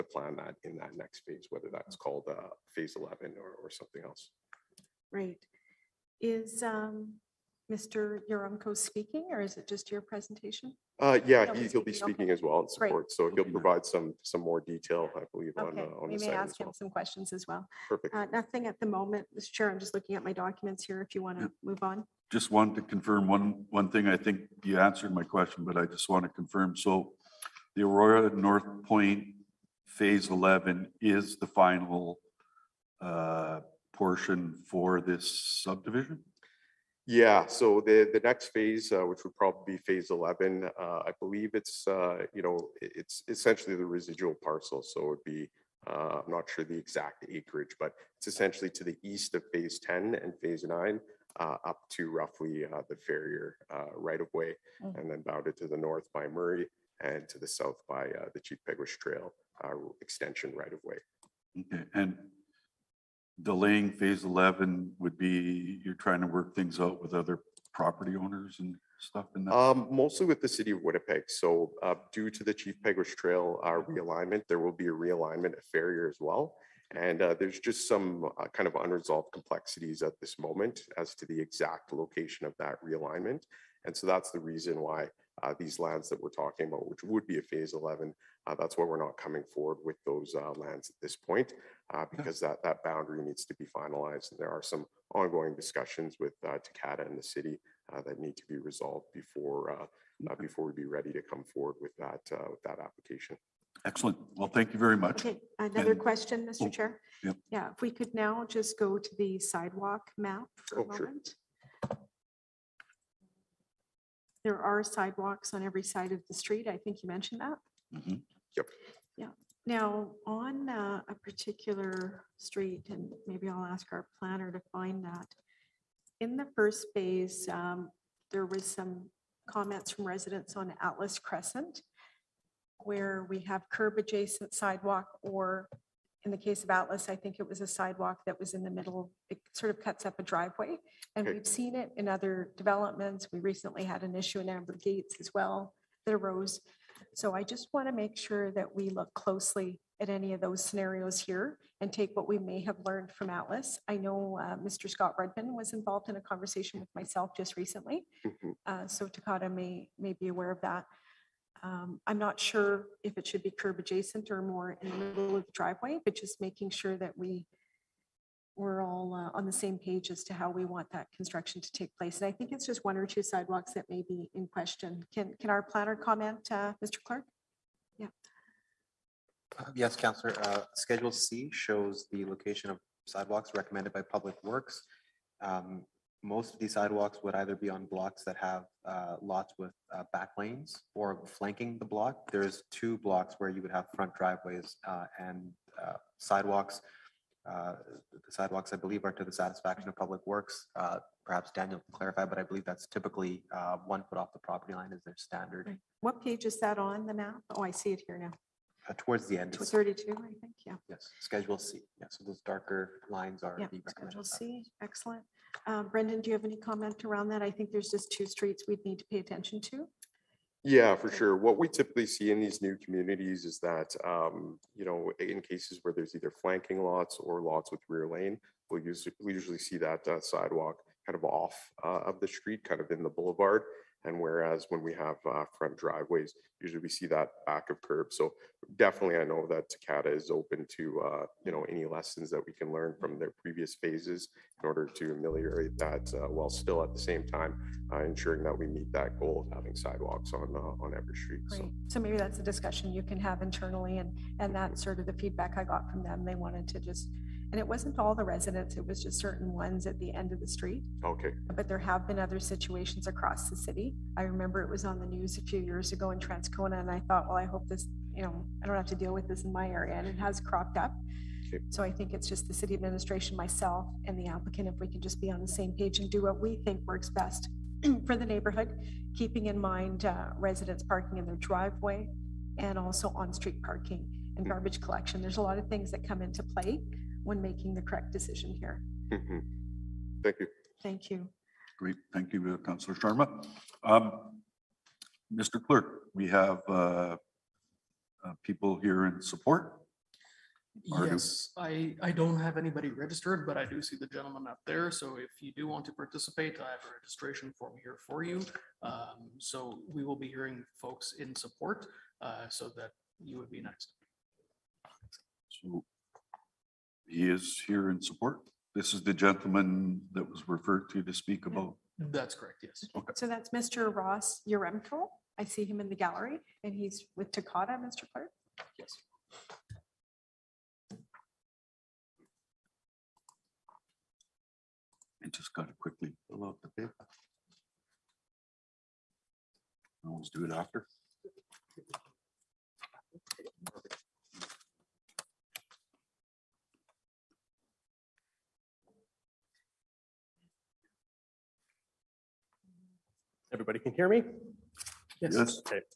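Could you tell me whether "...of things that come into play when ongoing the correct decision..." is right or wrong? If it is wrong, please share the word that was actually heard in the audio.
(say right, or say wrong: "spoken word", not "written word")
wrong: "making", not "ongoing".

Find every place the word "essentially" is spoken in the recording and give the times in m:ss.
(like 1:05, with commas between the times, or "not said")
0:43, 0:48.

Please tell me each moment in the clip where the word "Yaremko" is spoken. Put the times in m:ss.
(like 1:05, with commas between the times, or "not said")
0:08, 5:24.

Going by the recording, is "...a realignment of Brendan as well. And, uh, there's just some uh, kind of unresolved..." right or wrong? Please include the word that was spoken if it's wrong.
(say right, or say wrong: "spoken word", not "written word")
wrong: "Ferrier", not "Brendan".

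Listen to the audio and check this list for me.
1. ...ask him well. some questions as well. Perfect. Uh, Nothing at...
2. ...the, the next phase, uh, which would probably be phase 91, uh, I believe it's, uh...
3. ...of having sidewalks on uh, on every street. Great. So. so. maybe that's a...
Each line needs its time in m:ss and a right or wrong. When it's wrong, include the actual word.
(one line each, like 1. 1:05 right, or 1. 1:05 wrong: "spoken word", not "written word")
1. 0:16 right
2. 0:37 wrong: "11", not "91"
3. 4:09 right.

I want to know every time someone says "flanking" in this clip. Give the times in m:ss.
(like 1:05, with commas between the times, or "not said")
3:11, 3:46.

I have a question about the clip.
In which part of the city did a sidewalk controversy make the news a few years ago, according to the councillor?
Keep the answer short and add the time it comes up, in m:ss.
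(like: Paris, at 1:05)
Transcona, at 4:26.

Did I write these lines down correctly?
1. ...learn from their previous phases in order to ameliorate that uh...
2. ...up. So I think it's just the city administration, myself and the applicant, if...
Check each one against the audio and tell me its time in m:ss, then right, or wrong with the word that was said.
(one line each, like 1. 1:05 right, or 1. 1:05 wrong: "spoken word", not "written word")
1. 4:02 right
2. 4:30 right.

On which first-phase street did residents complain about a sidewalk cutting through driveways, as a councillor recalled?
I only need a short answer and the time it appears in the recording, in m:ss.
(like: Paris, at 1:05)
Atlas Crescent, at 2:10.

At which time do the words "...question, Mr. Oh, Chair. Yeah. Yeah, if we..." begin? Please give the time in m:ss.
1:46.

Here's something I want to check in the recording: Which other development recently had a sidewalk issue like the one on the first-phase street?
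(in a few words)
Amber Gates.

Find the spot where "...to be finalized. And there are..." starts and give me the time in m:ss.
1:33.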